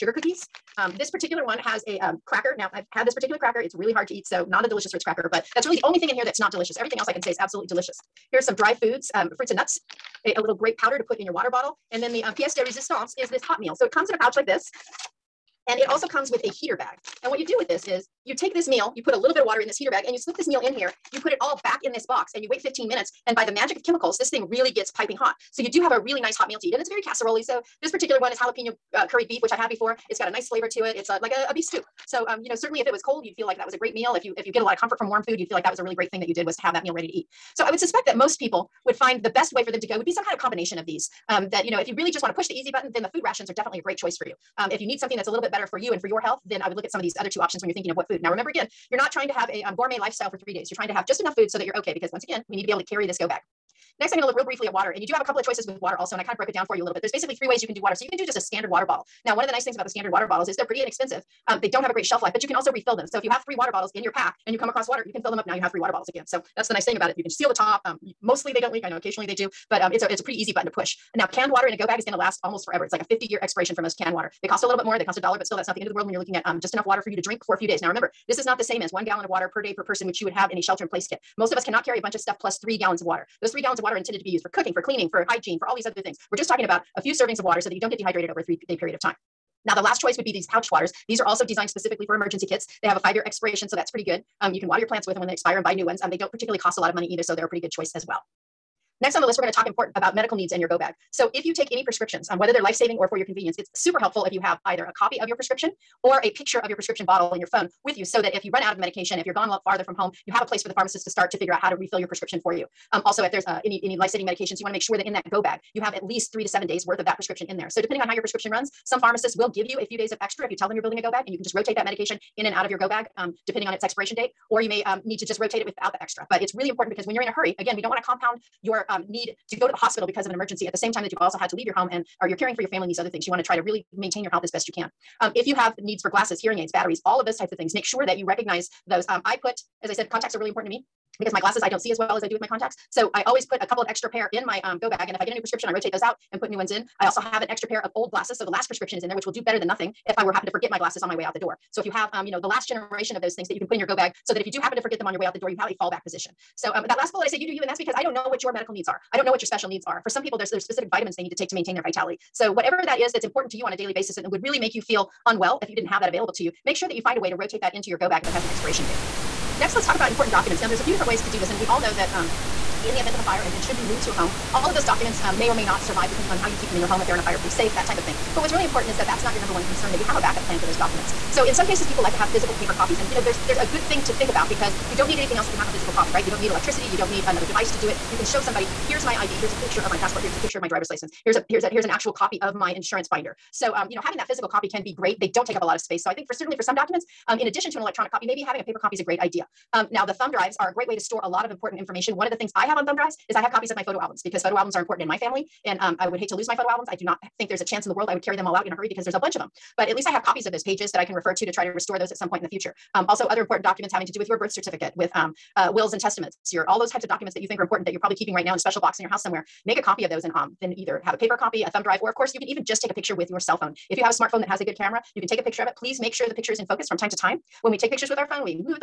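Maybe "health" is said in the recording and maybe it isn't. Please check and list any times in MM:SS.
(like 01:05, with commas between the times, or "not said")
00:46, 02:14.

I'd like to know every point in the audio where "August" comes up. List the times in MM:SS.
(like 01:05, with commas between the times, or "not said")
not said.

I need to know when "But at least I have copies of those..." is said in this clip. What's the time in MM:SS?
03:29.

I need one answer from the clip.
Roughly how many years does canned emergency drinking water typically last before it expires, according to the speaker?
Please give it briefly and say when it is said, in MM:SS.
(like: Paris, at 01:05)
50 years, at 01:13.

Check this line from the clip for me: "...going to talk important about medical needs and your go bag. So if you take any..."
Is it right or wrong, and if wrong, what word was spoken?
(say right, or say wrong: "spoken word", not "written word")
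right.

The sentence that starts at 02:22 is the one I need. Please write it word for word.
So I always put a couple of extra pair in my um, go bag.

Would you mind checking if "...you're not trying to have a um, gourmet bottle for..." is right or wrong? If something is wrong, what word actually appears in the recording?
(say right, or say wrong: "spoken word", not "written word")
wrong: "lifestyle", not "bottle".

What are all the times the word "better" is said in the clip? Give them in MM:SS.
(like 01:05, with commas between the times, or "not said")
00:45, 02:29.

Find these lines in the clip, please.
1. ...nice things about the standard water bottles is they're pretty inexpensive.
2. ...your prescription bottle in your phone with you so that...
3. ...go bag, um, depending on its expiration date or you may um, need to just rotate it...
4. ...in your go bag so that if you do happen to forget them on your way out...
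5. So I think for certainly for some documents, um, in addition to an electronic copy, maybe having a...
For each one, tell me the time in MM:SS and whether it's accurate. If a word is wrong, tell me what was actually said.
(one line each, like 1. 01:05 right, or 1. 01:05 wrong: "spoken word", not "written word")
1. 00:59 right
2. 01:46 right
3. 02:02 right
4. 02:33 right
5. 03:16 right.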